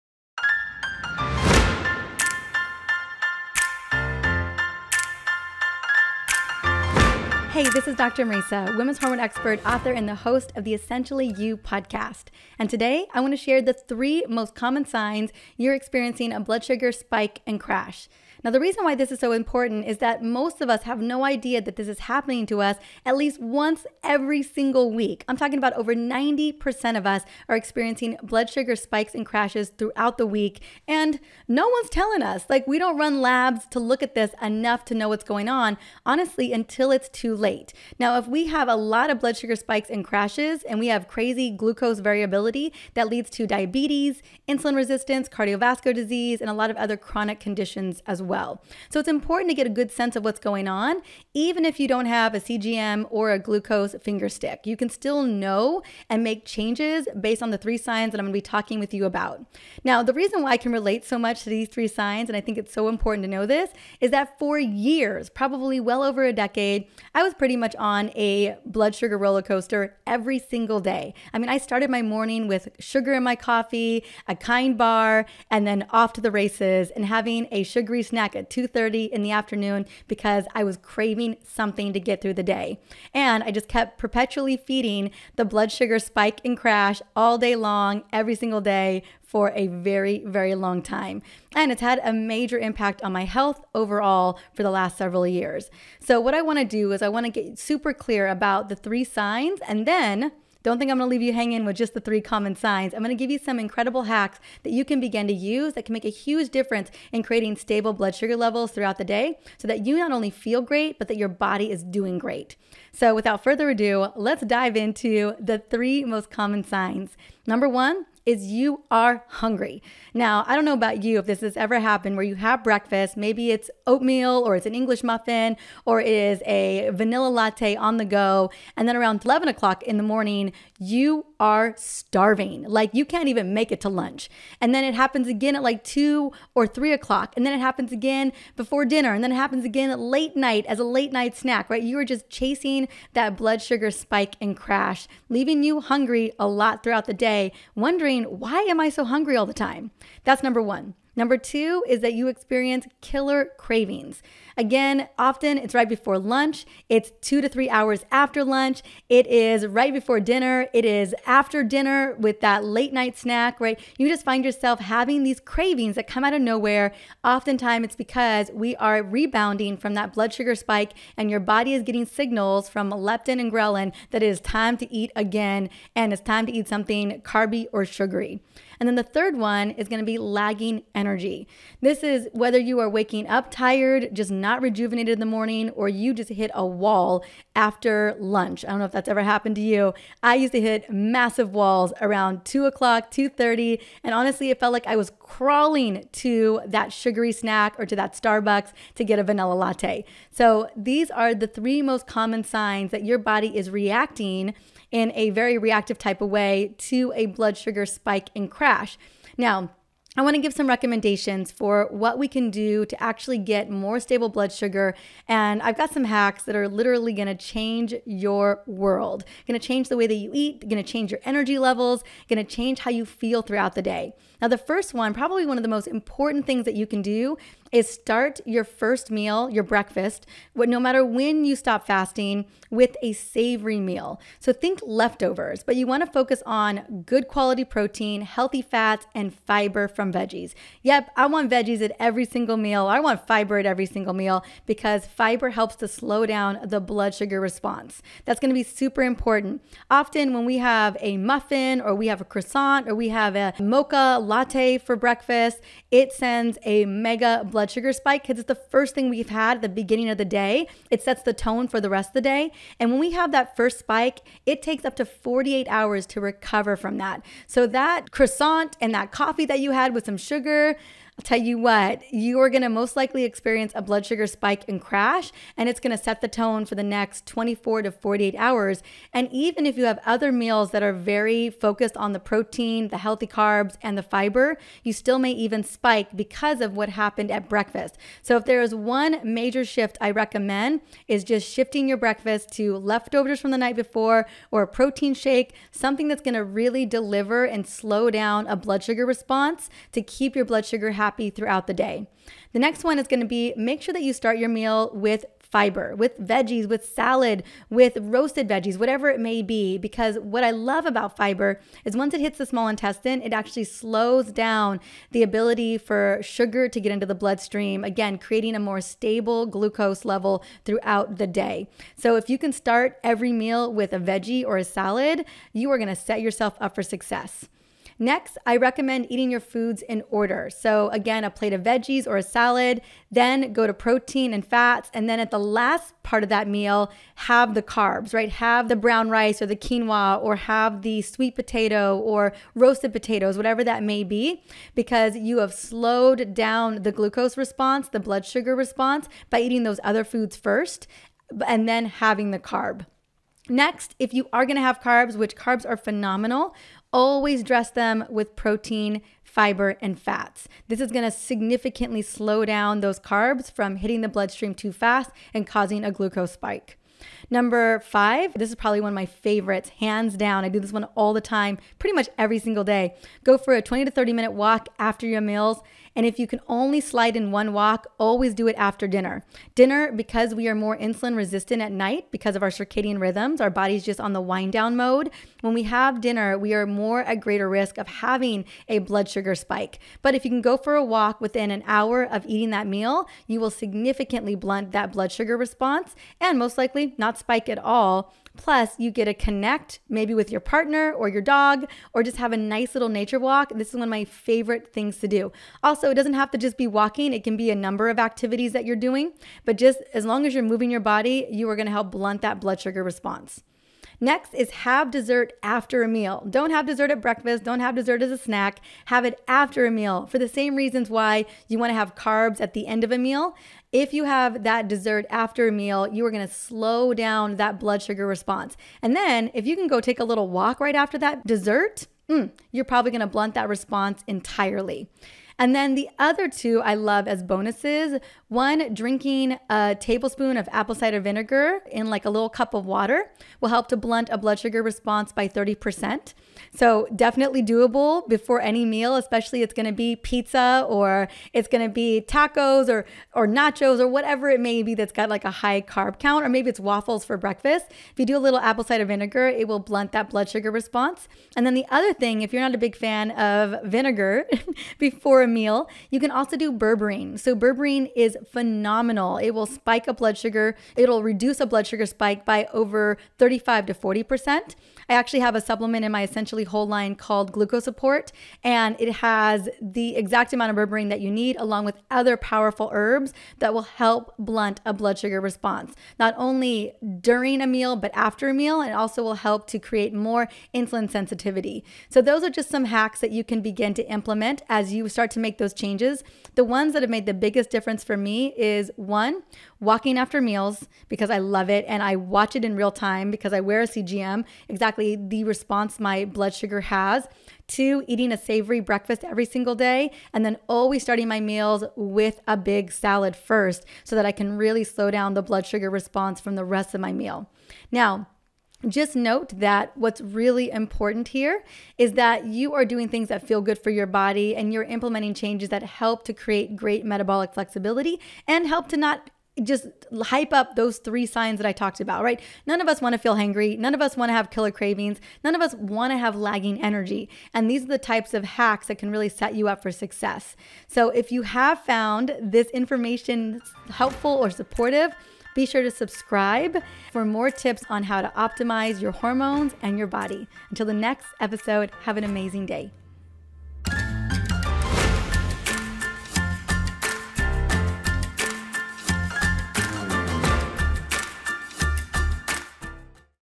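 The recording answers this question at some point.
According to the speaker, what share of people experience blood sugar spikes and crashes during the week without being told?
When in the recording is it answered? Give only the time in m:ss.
0:25.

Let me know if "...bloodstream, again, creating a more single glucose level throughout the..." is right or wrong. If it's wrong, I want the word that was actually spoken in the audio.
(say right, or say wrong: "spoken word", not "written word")
wrong: "stable", not "single".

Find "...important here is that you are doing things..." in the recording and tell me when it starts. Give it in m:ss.
8:40.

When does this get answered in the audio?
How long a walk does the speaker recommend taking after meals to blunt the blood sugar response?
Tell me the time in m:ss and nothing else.
6:13.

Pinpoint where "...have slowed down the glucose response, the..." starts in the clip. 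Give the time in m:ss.
5:45.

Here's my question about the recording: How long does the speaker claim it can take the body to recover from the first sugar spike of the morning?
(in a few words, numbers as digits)
up to 48 hours.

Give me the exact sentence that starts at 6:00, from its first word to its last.
This is gonna significantly slow down those carbs from hitting the bloodstream too fast and causing a glucose spike.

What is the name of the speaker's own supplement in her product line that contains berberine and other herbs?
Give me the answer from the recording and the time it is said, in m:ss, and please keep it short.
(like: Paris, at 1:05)
Glucose Support, at 7:57.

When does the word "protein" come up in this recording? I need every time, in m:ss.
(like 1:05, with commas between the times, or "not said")
3:57, 4:42, 4:54, 5:33, 5:58.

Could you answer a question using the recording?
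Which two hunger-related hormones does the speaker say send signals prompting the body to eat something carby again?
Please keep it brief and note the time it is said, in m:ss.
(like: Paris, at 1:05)
leptin and ghrelin, at 2:52.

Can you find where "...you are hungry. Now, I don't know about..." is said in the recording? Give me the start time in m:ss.
1:58.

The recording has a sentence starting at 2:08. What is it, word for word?
And then around 11 o'clock in the morning, you are starving.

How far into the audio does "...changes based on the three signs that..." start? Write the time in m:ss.
0:56.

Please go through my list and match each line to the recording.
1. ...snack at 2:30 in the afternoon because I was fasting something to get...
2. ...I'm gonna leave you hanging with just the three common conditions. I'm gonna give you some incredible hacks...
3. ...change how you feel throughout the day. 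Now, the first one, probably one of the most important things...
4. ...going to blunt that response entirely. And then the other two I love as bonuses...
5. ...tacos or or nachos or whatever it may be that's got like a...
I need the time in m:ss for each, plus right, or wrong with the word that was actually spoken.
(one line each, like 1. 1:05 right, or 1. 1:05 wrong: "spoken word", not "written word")
1. 1:18 wrong: "craving", not "fasting"
2. 1:40 wrong: "signs", not "conditions"
3. 3:42 right
4. 7:12 right
5. 7:32 right.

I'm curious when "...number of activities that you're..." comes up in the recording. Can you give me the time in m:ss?
6:47.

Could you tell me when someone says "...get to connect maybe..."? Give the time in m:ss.
6:38.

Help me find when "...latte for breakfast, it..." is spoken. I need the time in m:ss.
4:14.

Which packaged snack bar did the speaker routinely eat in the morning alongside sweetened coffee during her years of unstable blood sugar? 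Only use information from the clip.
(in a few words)
kind bar.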